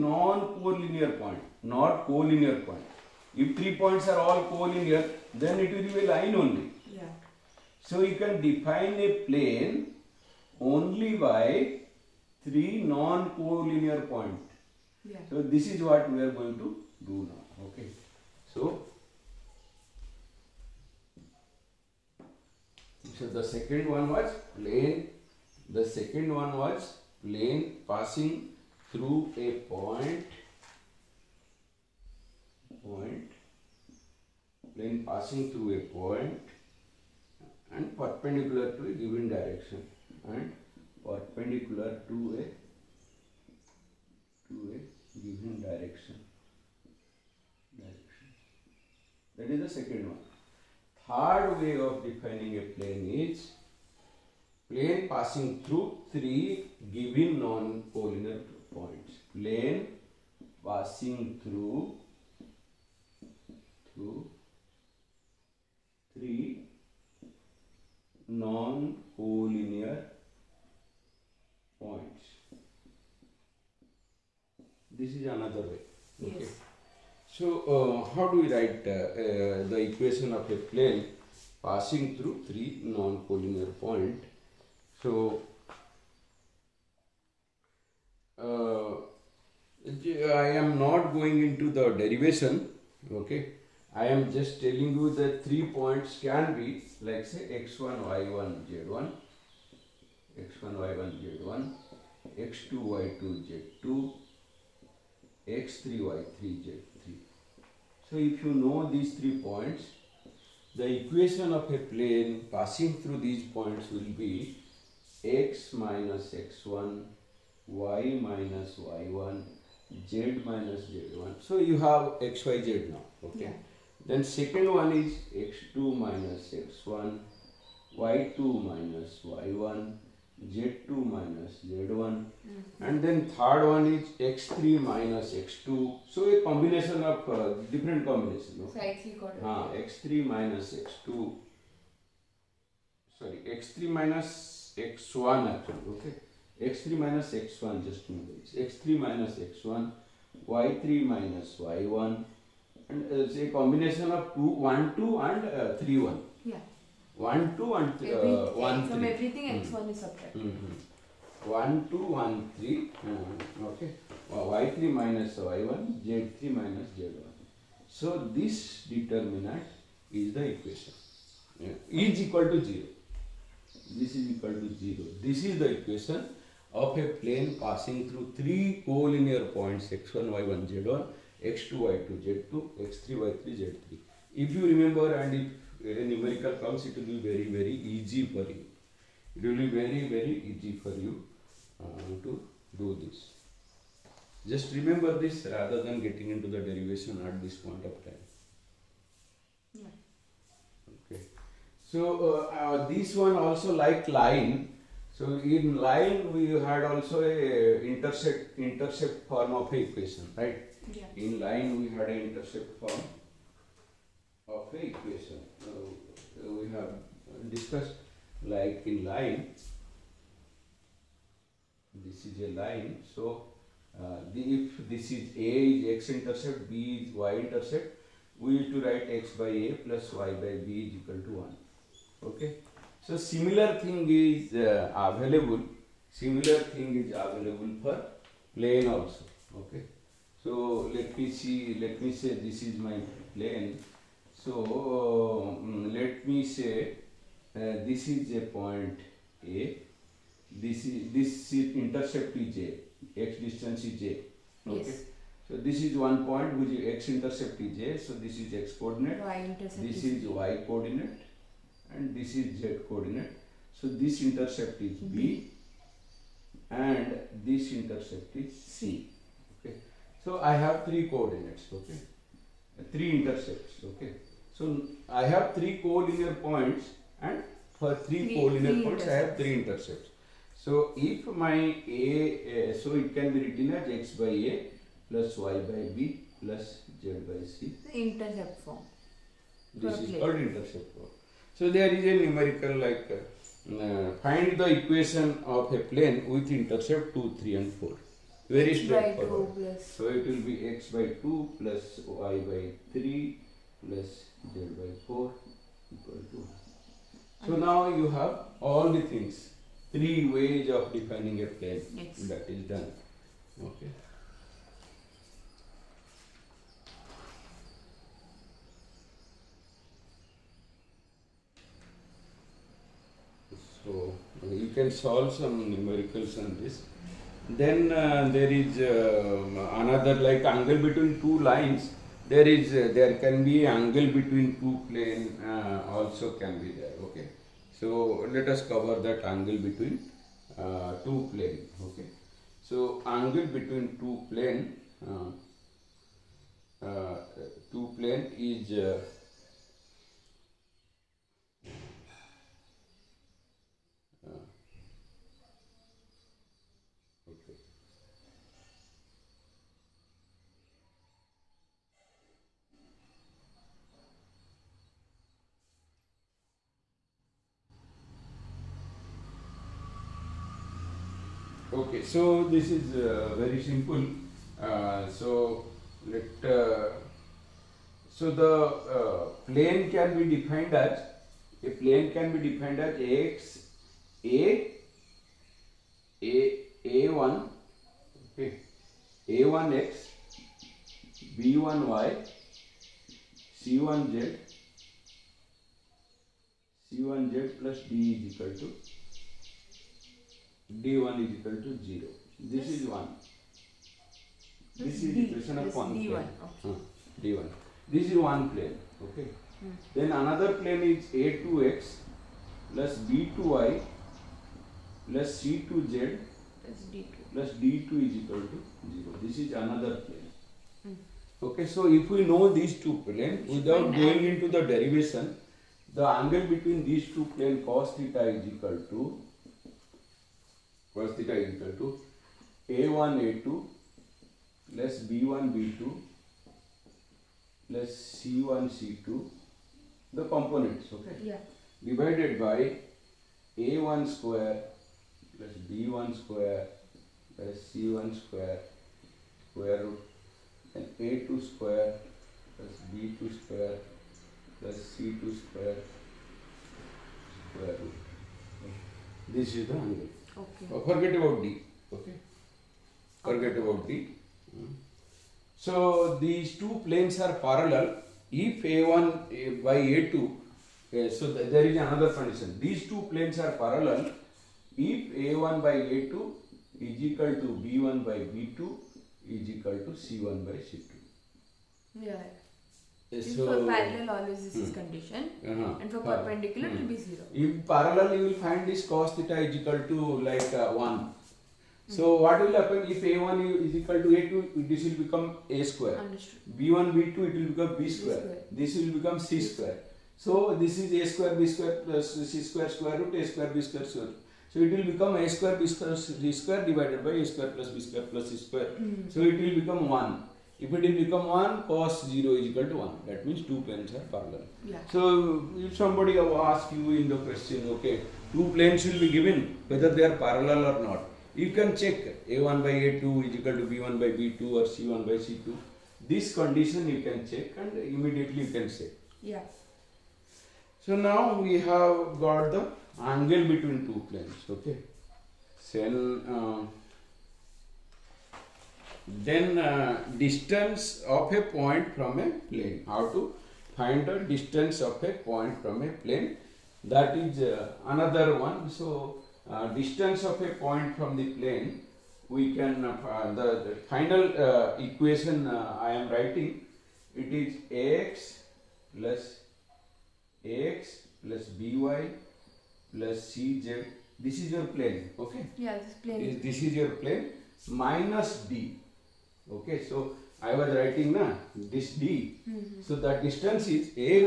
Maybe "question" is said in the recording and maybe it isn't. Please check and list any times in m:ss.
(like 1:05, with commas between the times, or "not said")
8:37.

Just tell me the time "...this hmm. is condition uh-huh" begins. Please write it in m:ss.
8:04.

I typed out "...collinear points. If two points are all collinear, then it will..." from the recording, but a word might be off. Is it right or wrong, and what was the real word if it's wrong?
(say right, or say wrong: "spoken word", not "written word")
wrong: "three", not "two".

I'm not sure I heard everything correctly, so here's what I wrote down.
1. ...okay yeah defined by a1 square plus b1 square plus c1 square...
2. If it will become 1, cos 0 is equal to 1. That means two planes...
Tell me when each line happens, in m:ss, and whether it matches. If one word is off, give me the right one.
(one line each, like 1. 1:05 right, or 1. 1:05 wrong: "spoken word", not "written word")
1. 7:20 wrong: "divided", not "defined"
2. 8:30 right.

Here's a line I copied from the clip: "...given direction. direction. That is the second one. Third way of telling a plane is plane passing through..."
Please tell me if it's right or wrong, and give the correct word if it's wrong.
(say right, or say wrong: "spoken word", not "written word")
wrong: "defining", not "telling".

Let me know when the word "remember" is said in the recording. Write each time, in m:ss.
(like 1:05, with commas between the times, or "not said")
2:28, 3:04, 3:14.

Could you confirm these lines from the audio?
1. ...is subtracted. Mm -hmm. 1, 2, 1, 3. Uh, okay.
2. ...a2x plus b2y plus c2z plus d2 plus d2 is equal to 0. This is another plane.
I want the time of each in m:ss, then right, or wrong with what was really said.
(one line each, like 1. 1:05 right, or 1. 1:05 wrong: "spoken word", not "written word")
1. 2:39 right
2. 6:51 right.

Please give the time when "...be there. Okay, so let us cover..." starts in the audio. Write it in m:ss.
5:36.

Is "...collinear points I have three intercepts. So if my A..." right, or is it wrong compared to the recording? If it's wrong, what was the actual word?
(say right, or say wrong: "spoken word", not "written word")
right.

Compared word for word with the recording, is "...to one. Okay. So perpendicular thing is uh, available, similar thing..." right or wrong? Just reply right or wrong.
wrong.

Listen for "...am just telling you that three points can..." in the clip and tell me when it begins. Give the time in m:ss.
1:34.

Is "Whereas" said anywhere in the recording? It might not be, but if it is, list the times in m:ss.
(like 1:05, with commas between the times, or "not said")
7:10.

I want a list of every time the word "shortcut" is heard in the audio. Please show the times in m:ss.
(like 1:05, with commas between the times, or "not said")
not said.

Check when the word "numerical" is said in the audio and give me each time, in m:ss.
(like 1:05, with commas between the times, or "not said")
3:06, 4:52, 5:25.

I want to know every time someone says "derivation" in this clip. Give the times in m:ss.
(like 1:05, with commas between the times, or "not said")
1:31, 3:16, 7:04.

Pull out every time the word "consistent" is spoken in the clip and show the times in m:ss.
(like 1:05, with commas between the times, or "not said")
not said.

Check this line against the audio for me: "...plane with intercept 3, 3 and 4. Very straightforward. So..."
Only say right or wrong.
wrong.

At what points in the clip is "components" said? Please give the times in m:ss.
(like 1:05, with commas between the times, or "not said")
7:20.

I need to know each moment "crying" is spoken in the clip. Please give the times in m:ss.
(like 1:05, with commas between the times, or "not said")
not said.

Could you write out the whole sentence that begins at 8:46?
This condition you can check and immediately you can say.